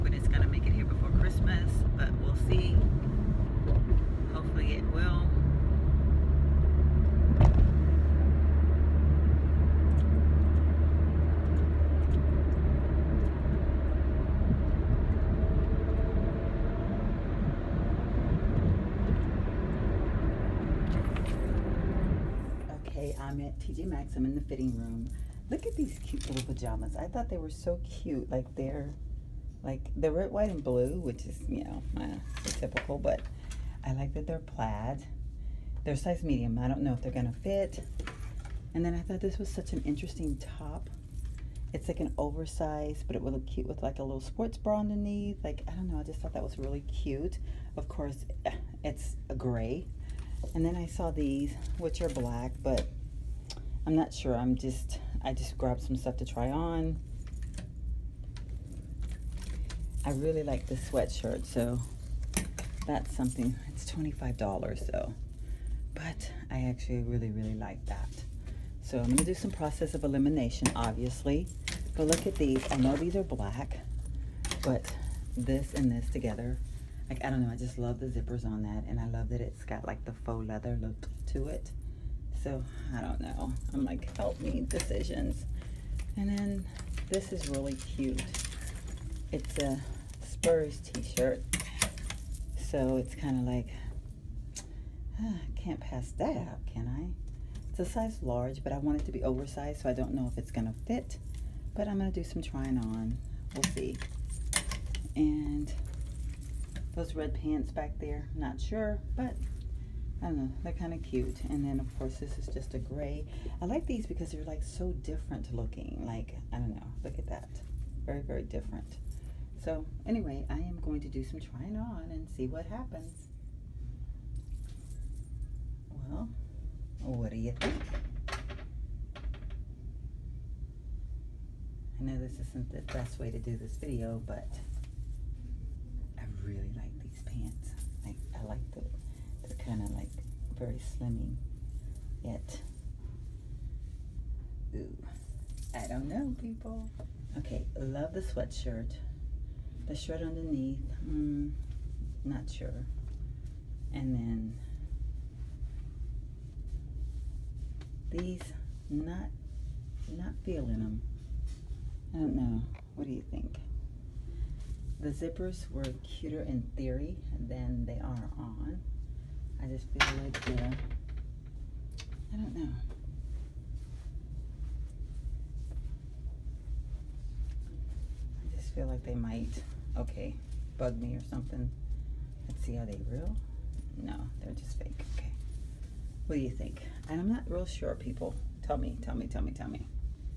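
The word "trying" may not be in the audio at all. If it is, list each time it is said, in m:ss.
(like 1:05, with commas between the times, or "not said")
1:42, 2:01.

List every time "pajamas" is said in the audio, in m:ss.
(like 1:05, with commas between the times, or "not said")
0:26.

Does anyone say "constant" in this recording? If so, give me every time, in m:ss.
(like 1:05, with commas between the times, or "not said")
not said.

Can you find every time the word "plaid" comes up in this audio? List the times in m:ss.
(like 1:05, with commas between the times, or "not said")
0:34.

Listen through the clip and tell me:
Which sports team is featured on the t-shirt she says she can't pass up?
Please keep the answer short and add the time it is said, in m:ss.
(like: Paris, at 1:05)
Spurs, at 1:30.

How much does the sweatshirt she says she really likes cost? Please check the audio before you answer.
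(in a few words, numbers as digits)
$25.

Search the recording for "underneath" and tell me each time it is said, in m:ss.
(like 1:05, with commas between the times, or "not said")
0:44, 2:30.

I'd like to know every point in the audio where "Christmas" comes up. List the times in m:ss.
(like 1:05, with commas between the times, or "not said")
0:01.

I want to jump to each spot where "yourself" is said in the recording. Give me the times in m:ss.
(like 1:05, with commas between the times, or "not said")
not said.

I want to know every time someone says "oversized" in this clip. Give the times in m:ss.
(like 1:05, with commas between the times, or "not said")
0:42, 1:39.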